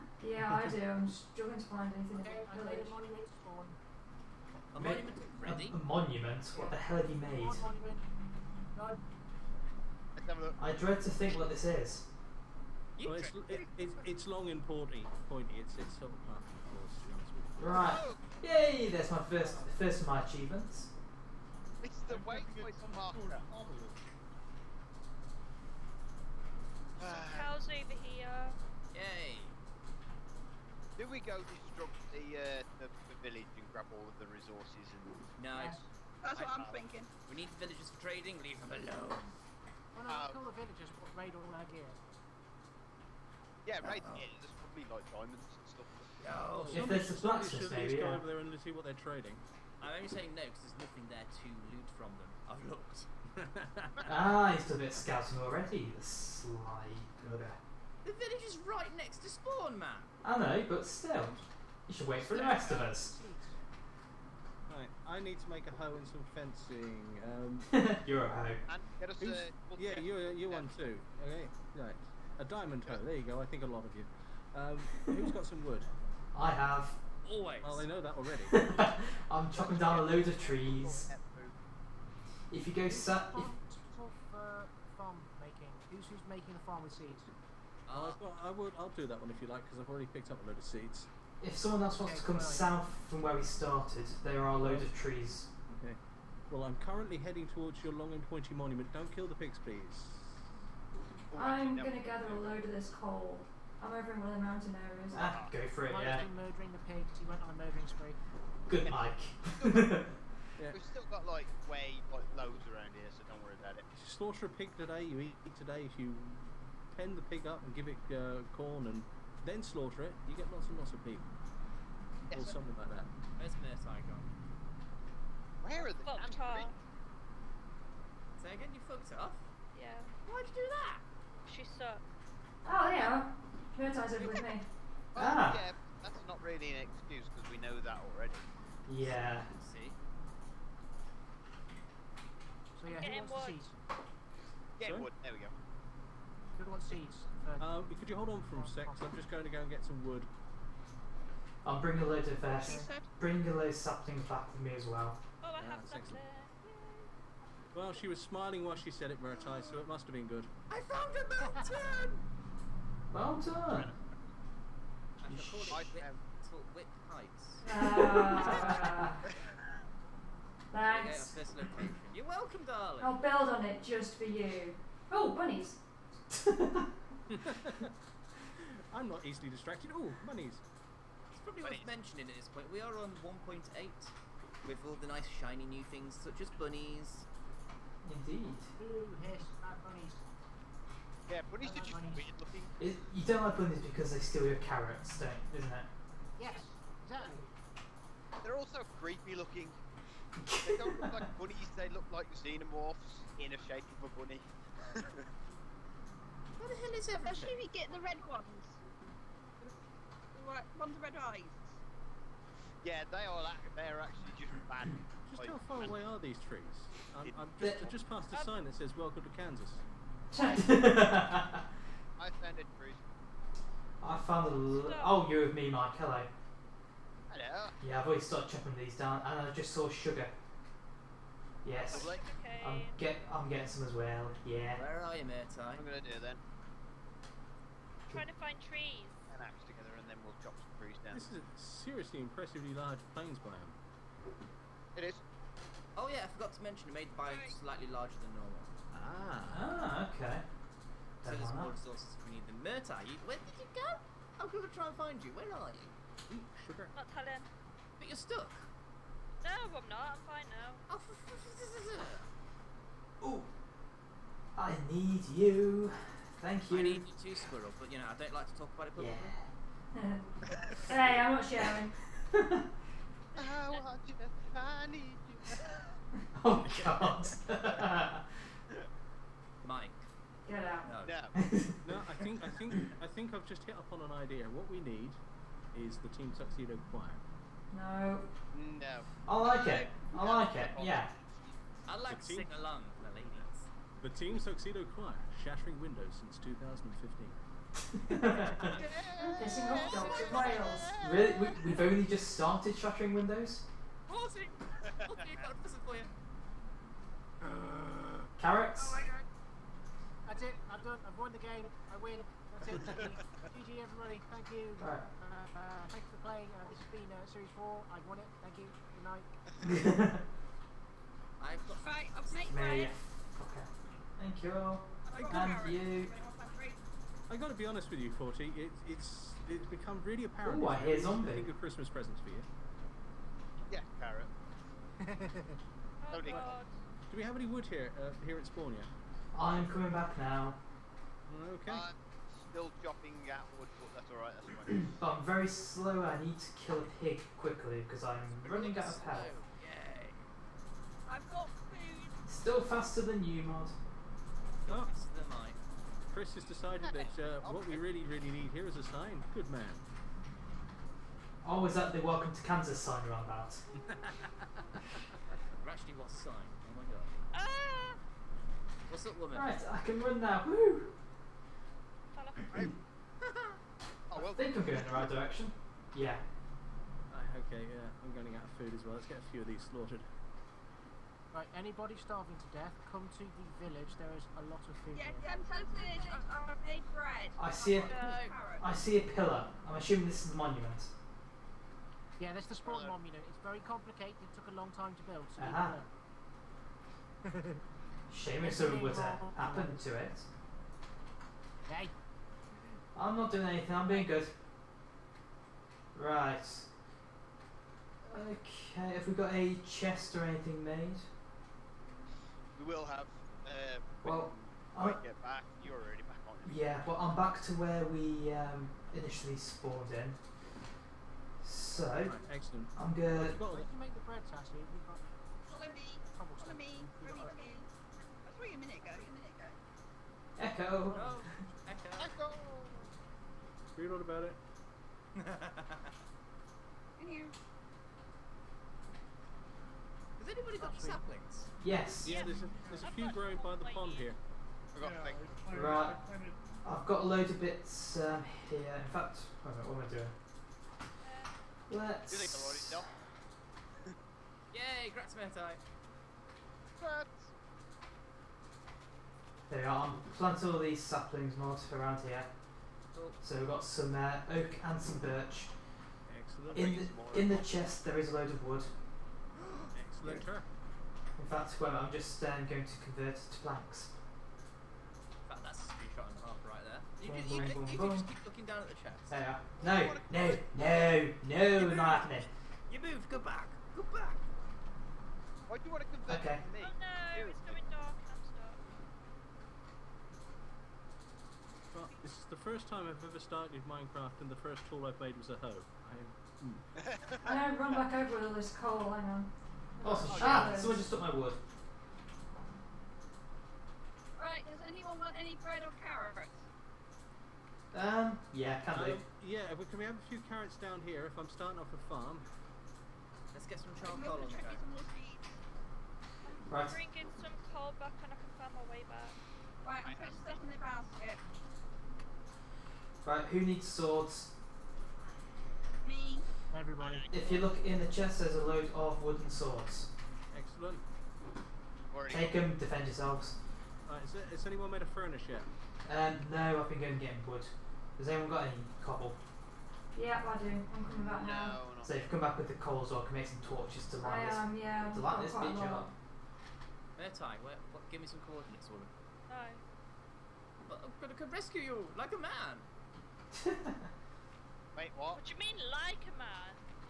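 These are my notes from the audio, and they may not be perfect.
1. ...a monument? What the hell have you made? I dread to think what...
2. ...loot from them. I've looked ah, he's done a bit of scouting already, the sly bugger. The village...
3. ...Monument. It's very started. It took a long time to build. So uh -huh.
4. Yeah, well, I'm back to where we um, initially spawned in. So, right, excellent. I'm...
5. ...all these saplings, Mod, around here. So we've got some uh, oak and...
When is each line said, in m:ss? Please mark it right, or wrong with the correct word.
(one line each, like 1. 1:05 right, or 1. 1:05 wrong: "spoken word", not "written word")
1. 0:05 right
2. 0:51 right
3. 6:32 wrong: "complicated", not "started"
4. 6:56 right
5. 7:40 right.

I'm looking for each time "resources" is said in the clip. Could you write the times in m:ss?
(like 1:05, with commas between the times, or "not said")
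0:34, 4:11.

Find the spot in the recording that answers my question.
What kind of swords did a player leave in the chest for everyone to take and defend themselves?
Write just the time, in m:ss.
8:49.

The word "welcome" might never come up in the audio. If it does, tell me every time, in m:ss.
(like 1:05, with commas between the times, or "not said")
2:52, 3:38, 6:02.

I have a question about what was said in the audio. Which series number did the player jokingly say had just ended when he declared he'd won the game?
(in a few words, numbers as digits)
Series 4.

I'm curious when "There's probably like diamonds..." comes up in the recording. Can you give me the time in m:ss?
0:44.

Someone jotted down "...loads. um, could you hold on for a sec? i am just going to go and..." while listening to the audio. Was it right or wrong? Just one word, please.
wrong.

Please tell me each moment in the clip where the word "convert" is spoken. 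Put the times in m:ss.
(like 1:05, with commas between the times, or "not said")
7:52, 8:05.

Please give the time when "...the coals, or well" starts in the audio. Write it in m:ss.
9:02.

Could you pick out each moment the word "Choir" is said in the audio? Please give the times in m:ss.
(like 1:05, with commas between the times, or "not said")
4:46, 4:54.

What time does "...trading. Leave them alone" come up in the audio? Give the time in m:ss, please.
0:38.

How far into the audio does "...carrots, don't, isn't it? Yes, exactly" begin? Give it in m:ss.
3:14.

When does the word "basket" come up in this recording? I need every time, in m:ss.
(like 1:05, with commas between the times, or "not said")
8:40.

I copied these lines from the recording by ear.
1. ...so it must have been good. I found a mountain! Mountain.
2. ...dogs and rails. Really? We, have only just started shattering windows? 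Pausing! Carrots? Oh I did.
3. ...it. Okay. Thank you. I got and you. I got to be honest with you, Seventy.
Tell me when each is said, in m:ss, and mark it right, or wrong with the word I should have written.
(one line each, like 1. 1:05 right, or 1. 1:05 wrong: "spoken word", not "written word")
1. 2:39 right
2. 4:59 right
3. 5:22 wrong: "Forty", not "Seventy".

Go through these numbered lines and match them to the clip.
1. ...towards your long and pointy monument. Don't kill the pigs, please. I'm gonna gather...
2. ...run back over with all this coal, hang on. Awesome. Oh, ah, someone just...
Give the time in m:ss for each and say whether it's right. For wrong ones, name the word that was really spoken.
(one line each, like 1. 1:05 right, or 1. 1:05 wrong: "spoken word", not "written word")
1. 1:37 right
2. 8:17 right.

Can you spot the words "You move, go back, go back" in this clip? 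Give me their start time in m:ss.
8:02.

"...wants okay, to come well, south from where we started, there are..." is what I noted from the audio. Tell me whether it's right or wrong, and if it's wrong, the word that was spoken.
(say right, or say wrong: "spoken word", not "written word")
right.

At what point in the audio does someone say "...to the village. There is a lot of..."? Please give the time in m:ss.
6:23.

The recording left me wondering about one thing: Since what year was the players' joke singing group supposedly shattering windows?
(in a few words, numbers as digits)
2015.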